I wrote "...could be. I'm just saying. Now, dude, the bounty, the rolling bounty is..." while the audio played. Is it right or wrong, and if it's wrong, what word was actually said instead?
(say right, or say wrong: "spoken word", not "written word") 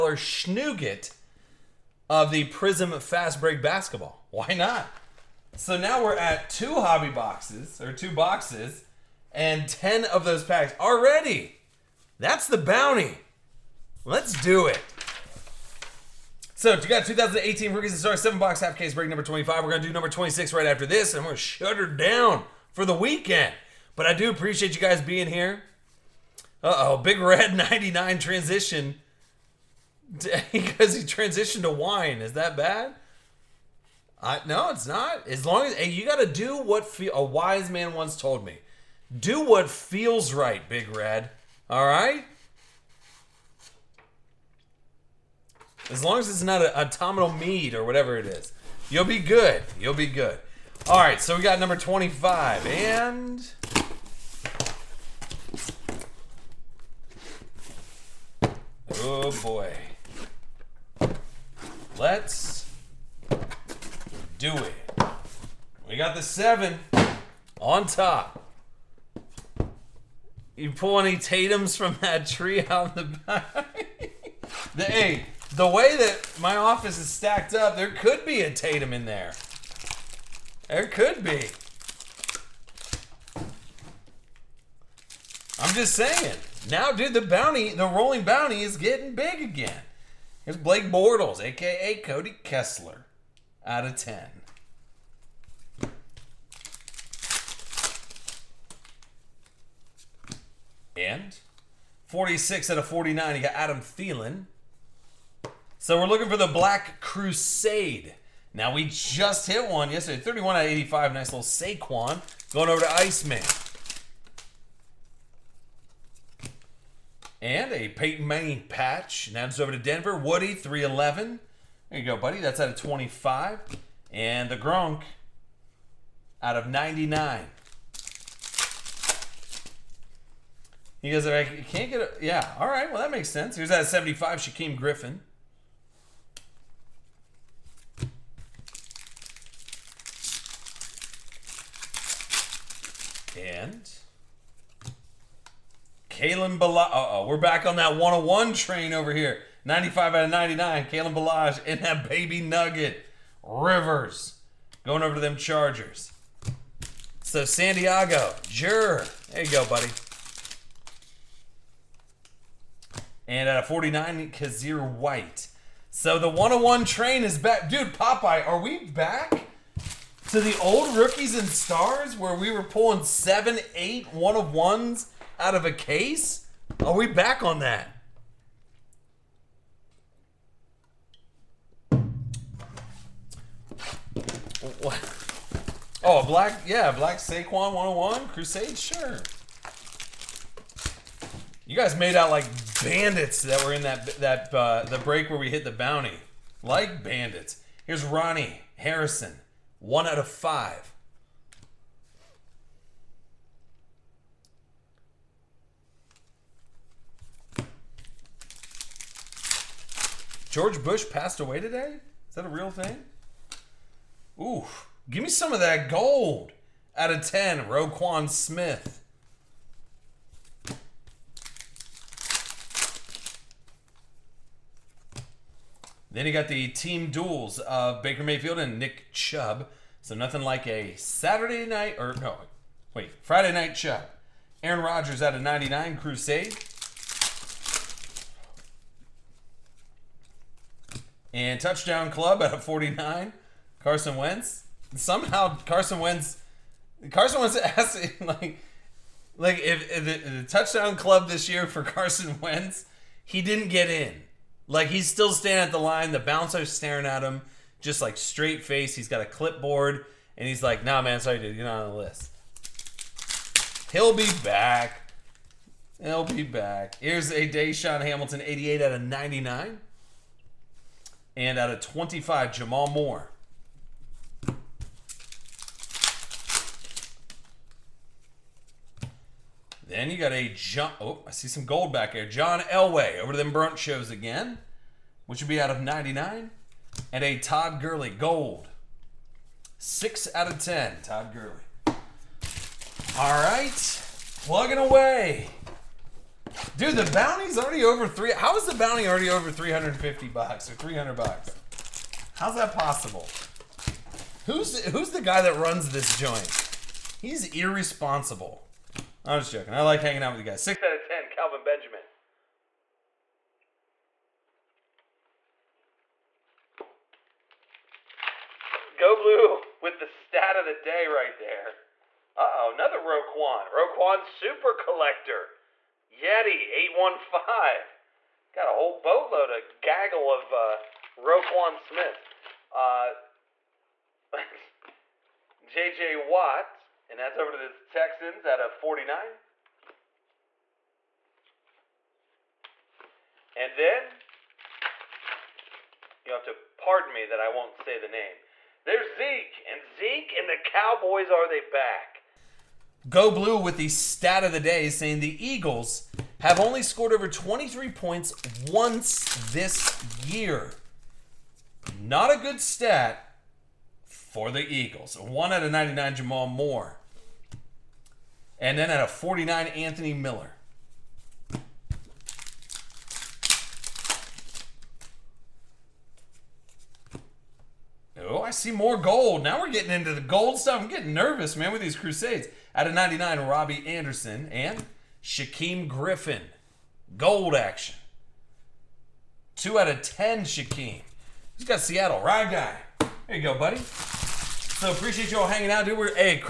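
right.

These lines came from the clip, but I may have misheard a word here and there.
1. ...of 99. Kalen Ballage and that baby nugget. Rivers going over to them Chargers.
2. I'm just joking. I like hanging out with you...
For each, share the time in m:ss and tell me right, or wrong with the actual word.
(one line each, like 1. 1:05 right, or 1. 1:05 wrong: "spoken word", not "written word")
1. 2:30 right
2. 5:09 right.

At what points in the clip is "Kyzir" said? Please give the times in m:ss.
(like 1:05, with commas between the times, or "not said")
2:44.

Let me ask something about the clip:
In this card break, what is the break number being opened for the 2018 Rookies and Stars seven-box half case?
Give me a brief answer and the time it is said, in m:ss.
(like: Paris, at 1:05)
25, at 0:18.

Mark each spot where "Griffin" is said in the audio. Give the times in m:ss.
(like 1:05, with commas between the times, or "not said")
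2:14, 6:25.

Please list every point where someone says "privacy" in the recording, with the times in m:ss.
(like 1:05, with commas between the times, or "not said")
not said.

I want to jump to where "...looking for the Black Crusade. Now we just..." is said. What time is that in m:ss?
1:46.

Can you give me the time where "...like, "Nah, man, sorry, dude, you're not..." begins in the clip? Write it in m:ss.
4:20.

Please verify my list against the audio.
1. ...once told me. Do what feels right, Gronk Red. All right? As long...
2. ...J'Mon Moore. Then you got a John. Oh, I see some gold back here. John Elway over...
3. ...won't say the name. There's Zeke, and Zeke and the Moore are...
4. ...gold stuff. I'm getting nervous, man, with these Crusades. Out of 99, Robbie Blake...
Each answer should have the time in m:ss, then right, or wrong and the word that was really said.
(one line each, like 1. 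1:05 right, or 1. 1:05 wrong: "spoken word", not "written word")
1. 0:37 wrong: "Big", not "Gronk"
2. 4:32 right
3. 5:47 wrong: "Cowboys", not "Moore"
4. 6:20 wrong: "Anderson", not "Blake".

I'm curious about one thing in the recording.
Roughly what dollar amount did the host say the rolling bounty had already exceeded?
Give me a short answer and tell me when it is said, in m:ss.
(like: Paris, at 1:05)
$350, at 4:59.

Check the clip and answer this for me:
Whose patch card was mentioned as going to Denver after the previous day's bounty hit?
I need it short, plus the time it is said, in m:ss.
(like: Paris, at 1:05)
Peyton Manning, at 1:57.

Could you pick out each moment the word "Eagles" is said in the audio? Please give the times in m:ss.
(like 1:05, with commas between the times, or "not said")
5:55, 6:04.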